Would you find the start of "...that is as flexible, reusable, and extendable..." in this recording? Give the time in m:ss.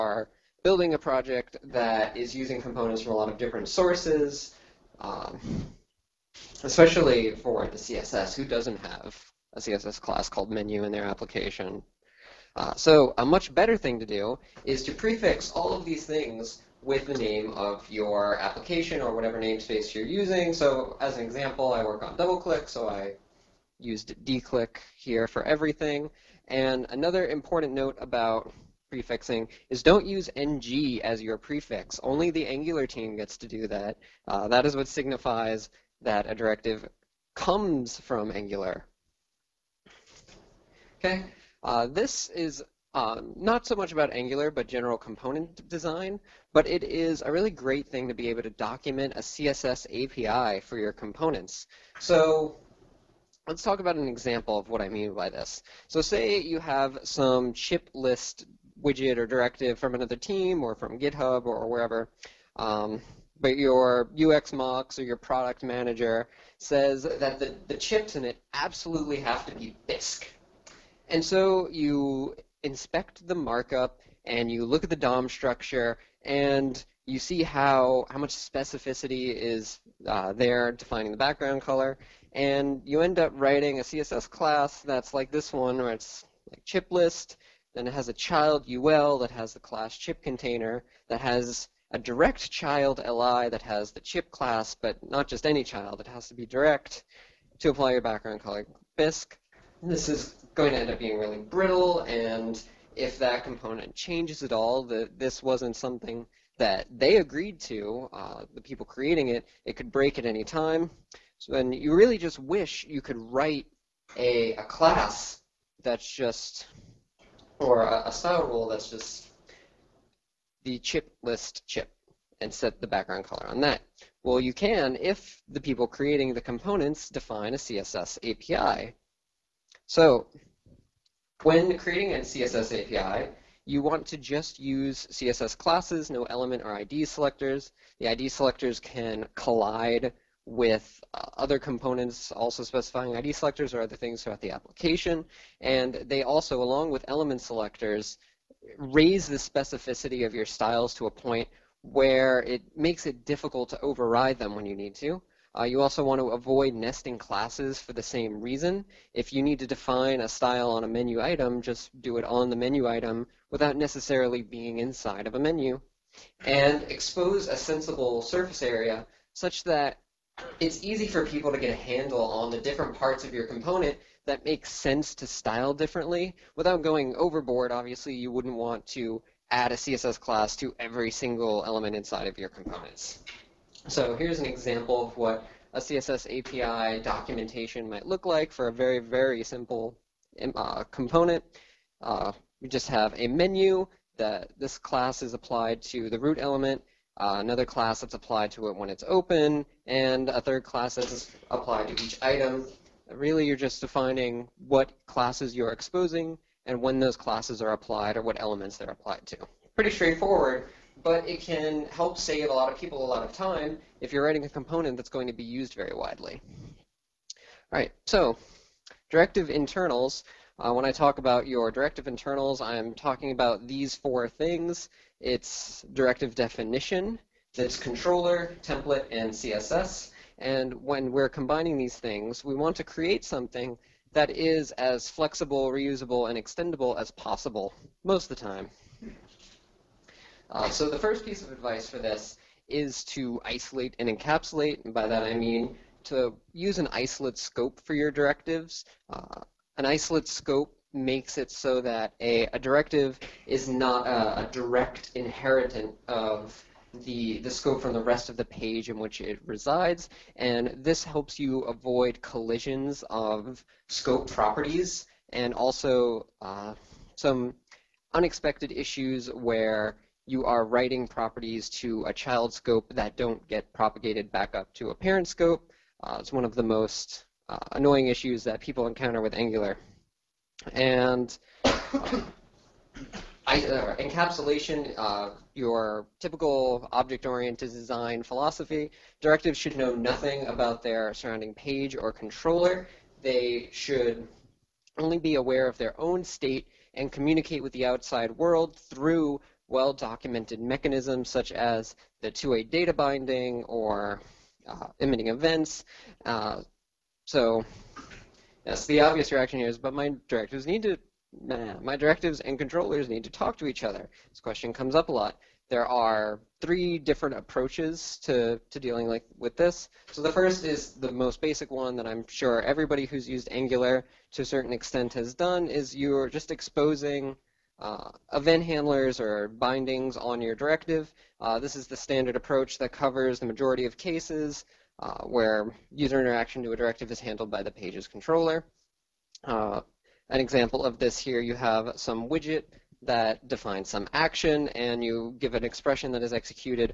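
3:54.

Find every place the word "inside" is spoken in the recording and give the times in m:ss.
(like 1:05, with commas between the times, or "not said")
2:44, 3:01.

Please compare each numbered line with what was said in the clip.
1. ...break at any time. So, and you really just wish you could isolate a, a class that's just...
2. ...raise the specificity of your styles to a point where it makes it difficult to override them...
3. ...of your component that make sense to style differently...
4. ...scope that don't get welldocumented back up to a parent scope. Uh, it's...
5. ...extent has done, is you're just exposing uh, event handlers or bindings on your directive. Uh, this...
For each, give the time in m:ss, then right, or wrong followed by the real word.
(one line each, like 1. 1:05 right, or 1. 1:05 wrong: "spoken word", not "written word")
1. 1:49 wrong: "write", not "isolate"
2. 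2:28 right
3. 2:53 right
4. 4:32 wrong: "propagated", not "welldocumented"
5. 5:24 right.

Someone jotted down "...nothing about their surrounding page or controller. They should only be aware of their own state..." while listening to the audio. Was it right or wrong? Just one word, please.
right.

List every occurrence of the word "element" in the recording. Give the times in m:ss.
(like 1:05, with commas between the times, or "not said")
2:16, 2:27, 3:01, 3:16, 3:28.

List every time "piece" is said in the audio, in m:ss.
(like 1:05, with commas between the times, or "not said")
4:01.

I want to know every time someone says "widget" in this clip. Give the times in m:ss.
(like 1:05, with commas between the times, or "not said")
0:58, 5:42.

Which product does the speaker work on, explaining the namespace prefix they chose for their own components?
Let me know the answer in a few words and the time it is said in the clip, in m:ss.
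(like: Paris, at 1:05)
DoubleClick, at 0:22.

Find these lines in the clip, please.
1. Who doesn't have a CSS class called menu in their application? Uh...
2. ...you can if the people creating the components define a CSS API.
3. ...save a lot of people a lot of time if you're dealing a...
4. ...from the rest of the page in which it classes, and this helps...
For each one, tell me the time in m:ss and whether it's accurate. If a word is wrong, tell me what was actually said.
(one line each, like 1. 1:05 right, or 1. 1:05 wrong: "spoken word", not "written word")
1. 0:08 right
2. 2:04 right
3. 3:32 wrong: "writing", not "dealing"
4. 4:17 wrong: "resides", not "classes".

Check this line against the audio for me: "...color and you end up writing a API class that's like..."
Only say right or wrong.
wrong.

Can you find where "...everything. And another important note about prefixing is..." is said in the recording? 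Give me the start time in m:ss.
0:25.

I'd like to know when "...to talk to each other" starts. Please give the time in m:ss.
5:13.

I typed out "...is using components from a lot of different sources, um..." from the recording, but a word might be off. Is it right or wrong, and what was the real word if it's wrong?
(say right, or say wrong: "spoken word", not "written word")
right.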